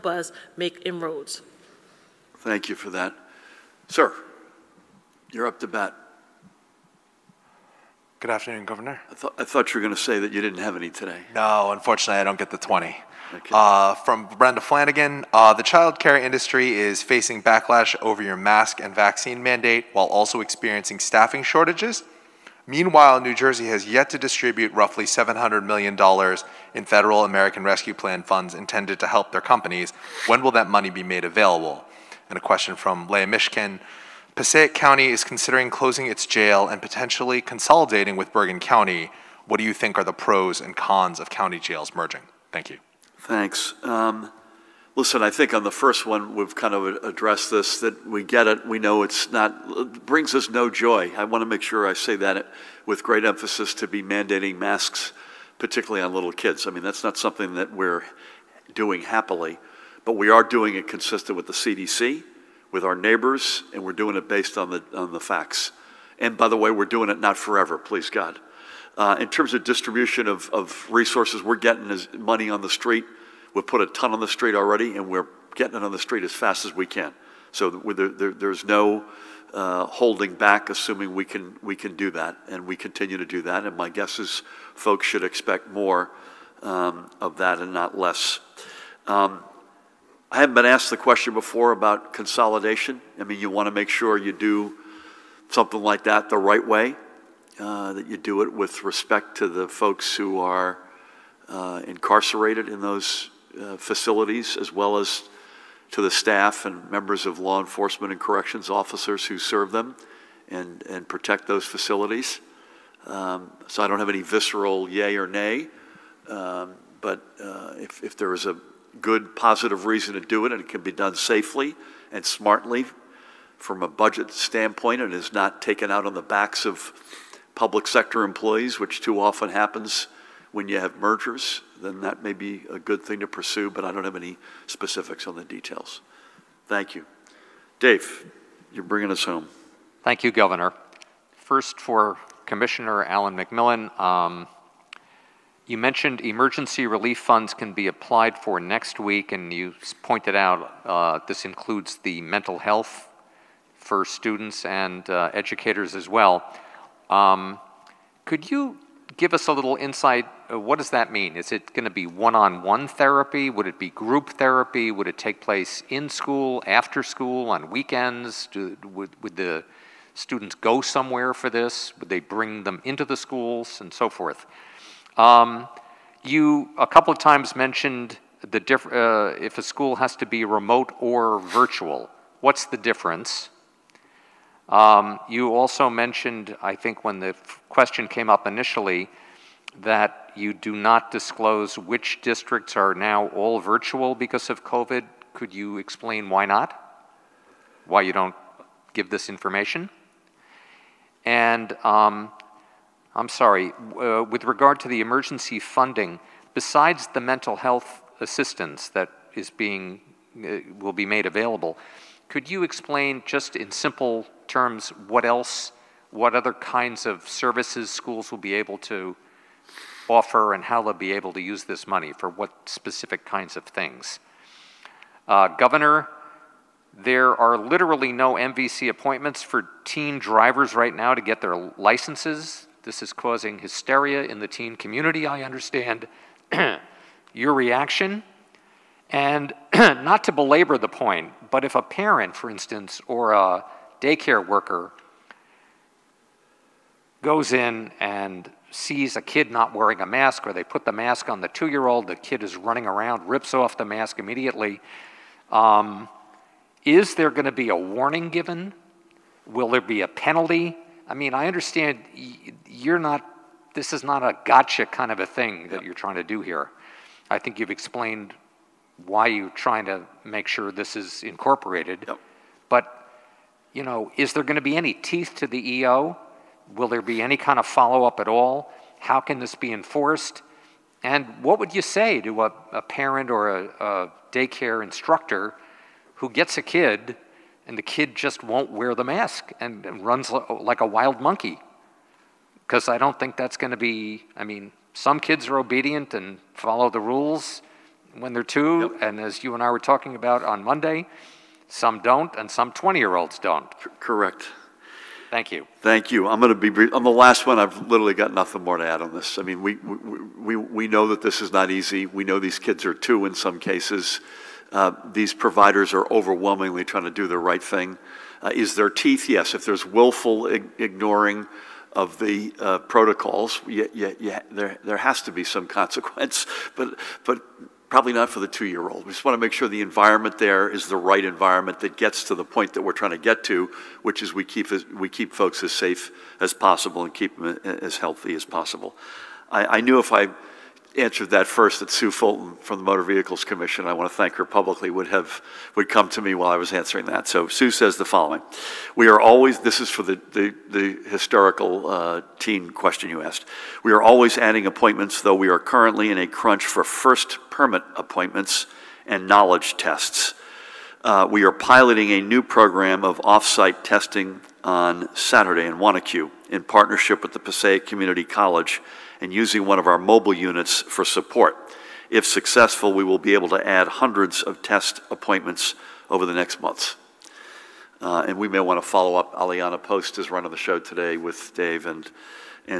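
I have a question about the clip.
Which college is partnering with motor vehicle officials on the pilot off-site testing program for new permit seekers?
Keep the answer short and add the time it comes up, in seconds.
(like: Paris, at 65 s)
Passaic Community College, at 367 s.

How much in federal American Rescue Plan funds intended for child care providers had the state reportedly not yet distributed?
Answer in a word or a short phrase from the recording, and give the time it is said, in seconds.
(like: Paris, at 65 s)
$700 million, at 25 s.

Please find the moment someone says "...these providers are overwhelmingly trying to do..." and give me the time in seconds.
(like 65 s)
315 s.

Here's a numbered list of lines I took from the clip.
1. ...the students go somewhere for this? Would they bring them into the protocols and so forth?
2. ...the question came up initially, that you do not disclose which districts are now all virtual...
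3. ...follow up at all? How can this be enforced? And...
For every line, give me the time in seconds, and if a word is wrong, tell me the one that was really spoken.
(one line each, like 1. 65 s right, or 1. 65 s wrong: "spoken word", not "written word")
1. 169 s wrong: "schools", not "protocols"
2. 187 s right
3. 277 s right.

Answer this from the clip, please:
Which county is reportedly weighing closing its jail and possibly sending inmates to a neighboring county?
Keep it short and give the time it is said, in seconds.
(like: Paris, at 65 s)
Bergen County, at 38 s.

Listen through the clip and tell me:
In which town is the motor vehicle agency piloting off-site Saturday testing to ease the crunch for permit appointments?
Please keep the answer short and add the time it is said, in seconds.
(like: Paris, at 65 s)
Wanaque, at 365 s.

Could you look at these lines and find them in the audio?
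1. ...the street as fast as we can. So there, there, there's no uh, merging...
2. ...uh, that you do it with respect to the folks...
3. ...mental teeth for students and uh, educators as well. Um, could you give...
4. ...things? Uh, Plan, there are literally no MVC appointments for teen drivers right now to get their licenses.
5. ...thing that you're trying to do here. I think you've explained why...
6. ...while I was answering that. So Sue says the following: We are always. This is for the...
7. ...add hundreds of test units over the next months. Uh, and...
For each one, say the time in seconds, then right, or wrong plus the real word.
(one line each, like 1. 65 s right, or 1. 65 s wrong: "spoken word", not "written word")
1. 75 s wrong: "holding", not "merging"
2. 97 s right
3. 152 s wrong: "health", not "teeth"
4. 223 s wrong: "Governor", not "Plan"
5. 265 s right
6. 346 s right
7. 373 s wrong: "appointments", not "units".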